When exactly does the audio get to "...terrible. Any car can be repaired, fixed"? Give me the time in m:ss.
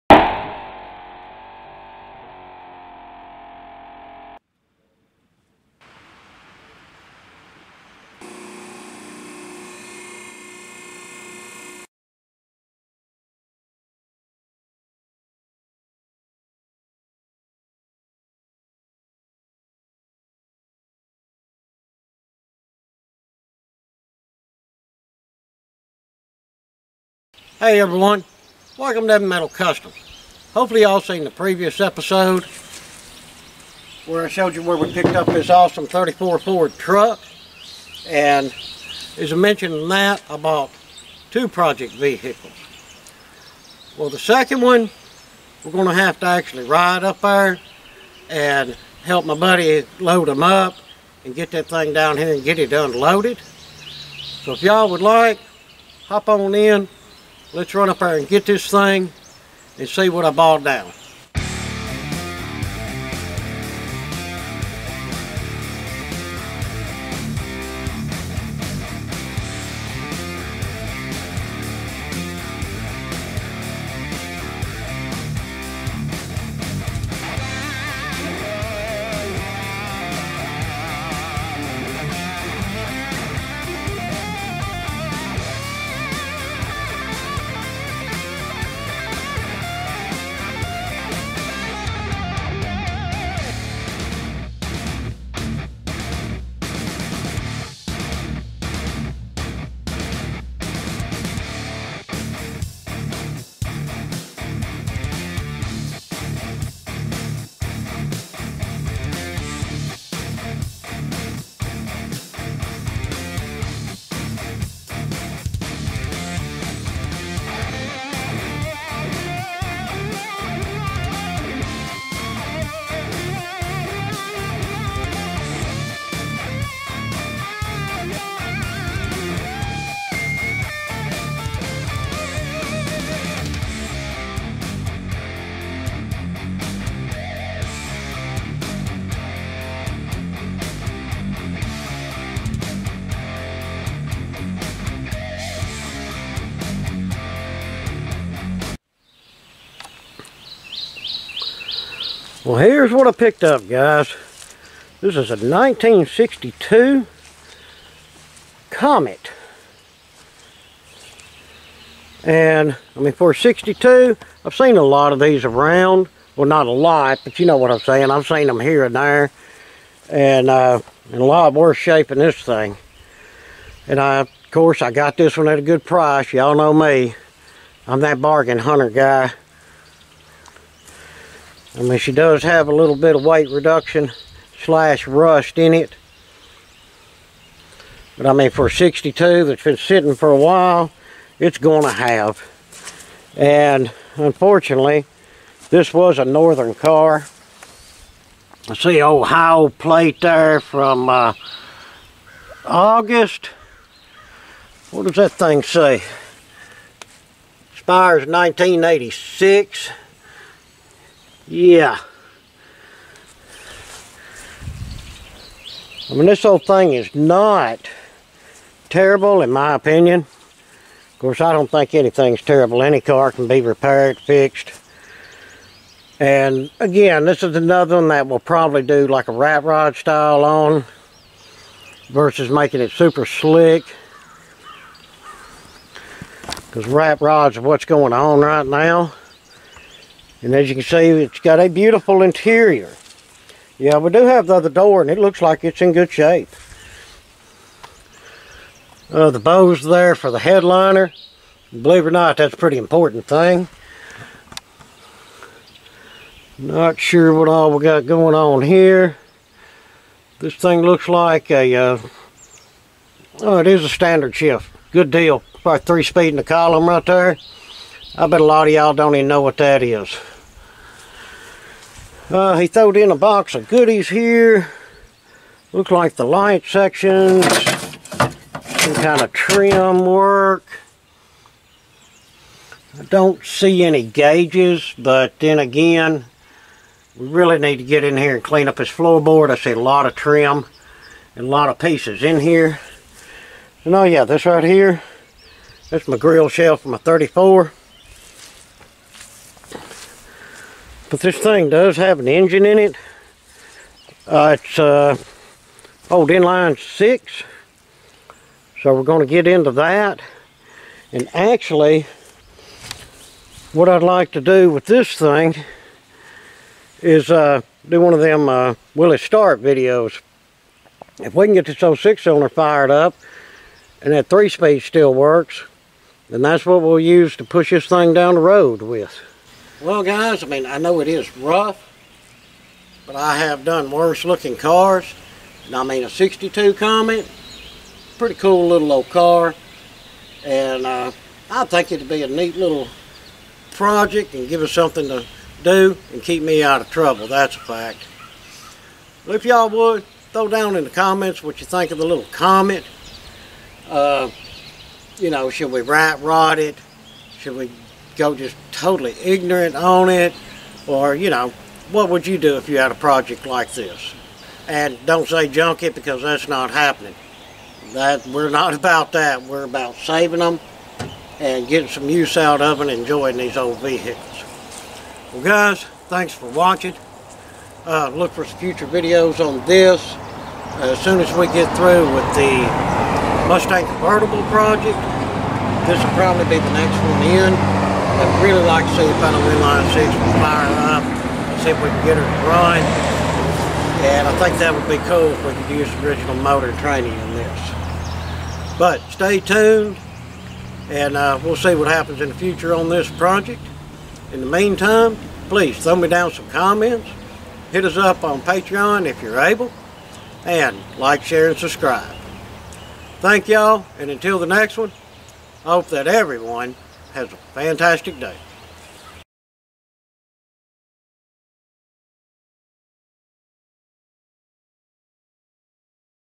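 3:42.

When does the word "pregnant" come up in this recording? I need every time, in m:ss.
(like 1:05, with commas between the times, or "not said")
not said.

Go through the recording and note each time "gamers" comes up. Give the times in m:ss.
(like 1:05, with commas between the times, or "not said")
not said.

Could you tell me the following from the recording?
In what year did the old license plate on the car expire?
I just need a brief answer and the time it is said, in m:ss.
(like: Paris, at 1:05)
1986, at 3:28.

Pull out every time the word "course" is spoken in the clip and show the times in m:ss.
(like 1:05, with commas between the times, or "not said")
2:54, 3:41.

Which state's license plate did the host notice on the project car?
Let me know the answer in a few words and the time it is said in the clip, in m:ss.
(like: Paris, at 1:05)
Ohio, at 3:19.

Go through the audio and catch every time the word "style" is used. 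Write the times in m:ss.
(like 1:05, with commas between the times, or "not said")
3:49.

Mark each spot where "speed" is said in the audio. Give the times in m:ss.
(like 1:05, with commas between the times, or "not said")
4:26, 5:24.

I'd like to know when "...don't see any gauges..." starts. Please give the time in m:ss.
4:43.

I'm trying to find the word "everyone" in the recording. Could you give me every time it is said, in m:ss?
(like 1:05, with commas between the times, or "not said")
0:27, 6:56.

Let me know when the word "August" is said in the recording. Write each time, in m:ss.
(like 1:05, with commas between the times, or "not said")
3:22.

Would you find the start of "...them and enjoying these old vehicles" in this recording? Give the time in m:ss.
6:12.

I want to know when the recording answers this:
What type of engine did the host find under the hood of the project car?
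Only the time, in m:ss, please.
5:06.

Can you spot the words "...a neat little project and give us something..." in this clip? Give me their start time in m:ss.
5:42.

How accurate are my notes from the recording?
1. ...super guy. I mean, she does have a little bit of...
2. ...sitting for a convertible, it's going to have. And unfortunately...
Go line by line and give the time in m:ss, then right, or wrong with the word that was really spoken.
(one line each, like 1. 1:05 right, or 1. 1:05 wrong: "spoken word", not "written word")
1. 2:58 wrong: "hunter", not "super"
2. 3:09 wrong: "while", not "convertible".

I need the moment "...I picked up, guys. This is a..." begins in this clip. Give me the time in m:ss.
2:33.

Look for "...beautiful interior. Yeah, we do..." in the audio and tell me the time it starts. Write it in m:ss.
4:01.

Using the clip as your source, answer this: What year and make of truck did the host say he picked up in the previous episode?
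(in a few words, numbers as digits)
34 Ford.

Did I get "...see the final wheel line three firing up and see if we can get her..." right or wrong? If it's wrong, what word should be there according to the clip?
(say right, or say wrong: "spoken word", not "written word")
wrong: "six", not "three".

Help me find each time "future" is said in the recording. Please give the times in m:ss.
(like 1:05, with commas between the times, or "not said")
6:18, 6:42.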